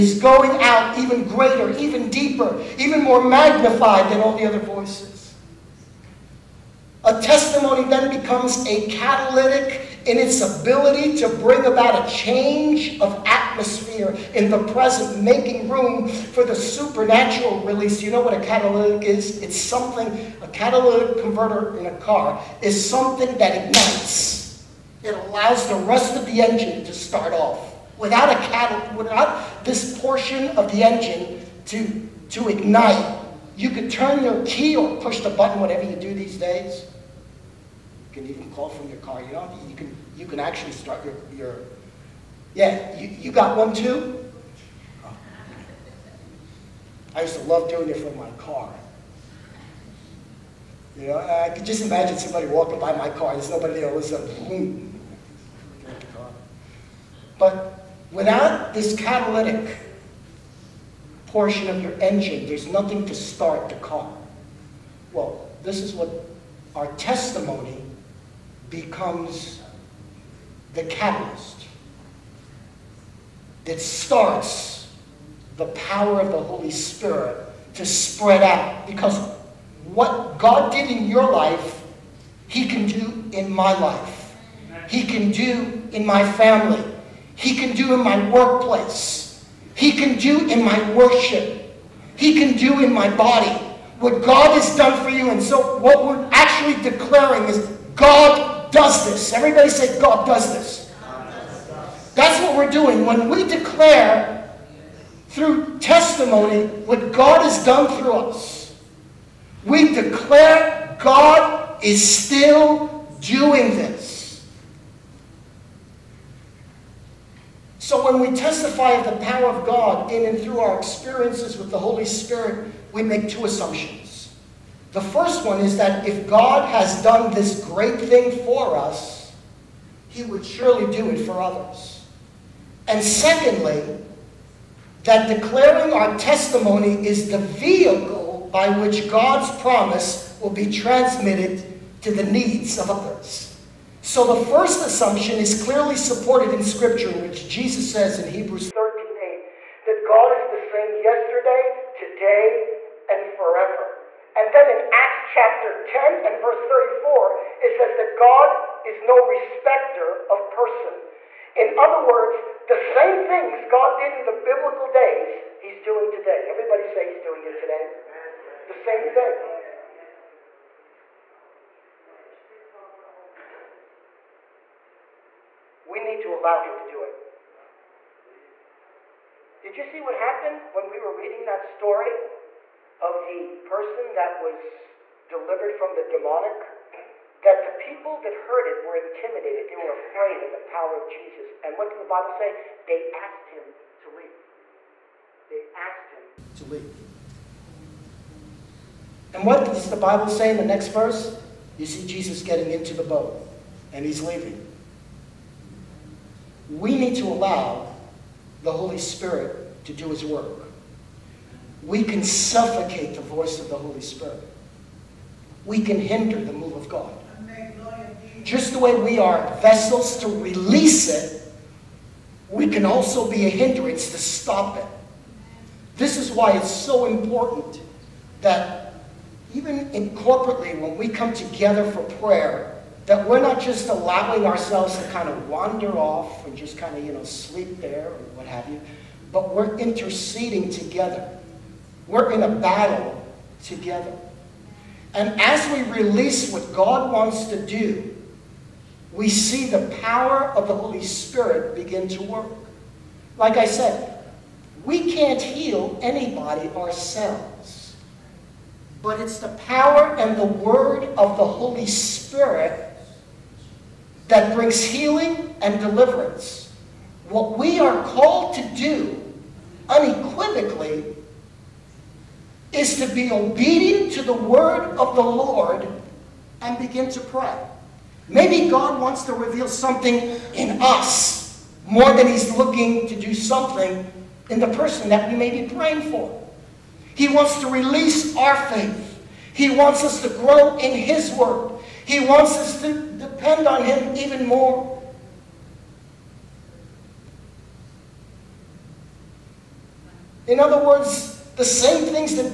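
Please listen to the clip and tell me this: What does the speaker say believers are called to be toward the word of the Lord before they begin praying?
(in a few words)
obedient.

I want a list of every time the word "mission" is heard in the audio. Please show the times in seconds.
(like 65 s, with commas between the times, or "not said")
not said.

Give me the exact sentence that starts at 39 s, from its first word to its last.
You know, you can, you can actually start your, your yeah, you, you got one too?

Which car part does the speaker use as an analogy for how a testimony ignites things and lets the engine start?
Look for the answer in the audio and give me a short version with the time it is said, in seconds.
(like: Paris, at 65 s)
catalytic converter, at 20 s.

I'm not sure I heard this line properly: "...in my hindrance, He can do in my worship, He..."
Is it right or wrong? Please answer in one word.
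wrong.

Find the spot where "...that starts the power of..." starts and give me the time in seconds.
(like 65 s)
73 s.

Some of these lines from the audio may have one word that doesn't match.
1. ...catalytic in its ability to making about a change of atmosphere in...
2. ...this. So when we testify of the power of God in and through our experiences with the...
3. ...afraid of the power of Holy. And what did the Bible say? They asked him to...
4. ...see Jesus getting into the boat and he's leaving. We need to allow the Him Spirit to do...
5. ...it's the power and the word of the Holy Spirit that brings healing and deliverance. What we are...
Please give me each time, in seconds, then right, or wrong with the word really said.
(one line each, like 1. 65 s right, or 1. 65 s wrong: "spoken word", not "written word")
1. 8 s wrong: "bring", not "making"
2. 113 s right
3. 189 s wrong: "Jesus", not "Holy"
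4. 201 s wrong: "Holy", not "Him"
5. 259 s right.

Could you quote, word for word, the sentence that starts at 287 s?
He wants to release our faith.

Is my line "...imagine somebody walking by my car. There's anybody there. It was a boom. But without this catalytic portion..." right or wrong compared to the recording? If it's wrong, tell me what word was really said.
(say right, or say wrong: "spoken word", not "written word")
wrong: "nobody", not "anybody".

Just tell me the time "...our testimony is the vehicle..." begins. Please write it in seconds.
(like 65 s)
135 s.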